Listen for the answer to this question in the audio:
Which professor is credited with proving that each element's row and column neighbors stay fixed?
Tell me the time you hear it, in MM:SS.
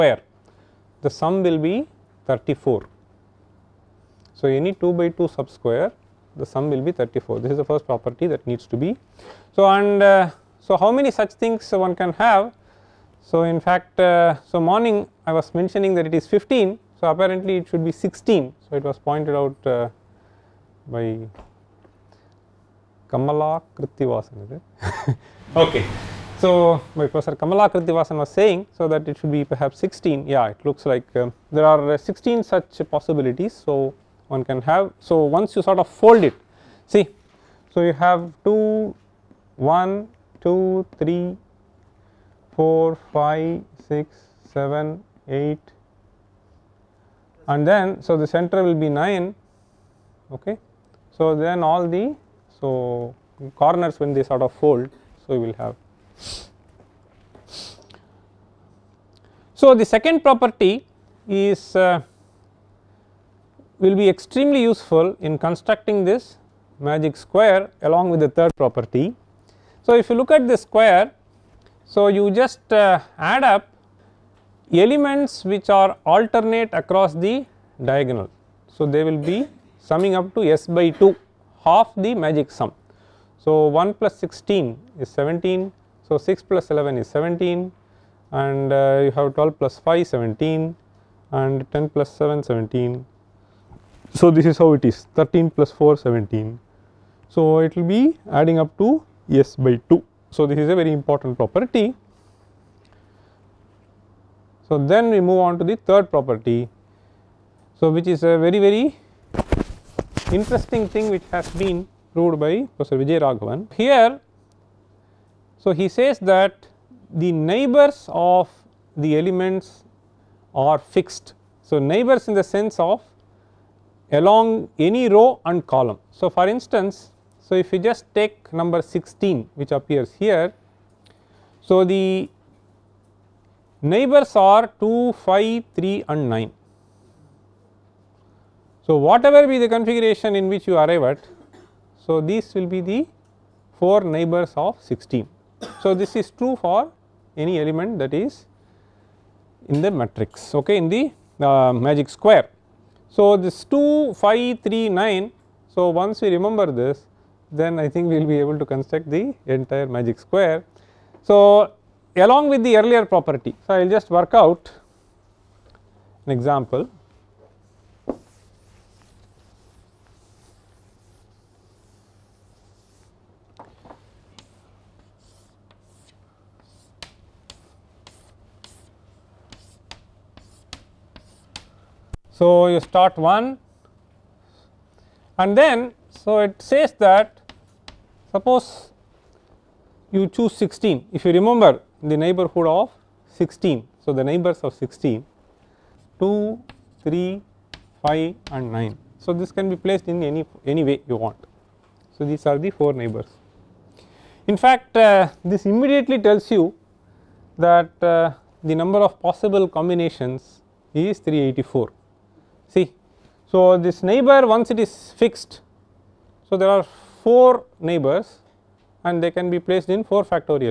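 01:52.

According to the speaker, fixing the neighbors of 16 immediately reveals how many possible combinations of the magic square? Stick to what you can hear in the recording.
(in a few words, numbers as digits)
384.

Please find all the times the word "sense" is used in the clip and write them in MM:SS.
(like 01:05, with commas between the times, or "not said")
02:02.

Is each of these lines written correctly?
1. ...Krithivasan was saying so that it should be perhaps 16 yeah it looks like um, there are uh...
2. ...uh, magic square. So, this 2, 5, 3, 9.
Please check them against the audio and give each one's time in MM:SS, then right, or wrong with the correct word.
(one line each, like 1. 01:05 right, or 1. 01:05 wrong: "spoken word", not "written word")
1. 00:27 right
2. 02:31 right.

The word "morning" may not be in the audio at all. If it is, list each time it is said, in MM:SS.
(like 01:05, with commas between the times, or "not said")
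00:14.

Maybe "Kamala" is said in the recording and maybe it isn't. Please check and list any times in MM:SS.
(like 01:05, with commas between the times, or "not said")
00:23, 00:27.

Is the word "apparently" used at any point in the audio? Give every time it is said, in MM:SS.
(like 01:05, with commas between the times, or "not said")
00:17.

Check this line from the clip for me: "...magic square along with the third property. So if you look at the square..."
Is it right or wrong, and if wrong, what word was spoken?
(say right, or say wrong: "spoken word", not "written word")
right.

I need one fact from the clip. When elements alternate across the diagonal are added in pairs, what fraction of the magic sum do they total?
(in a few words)
s/2.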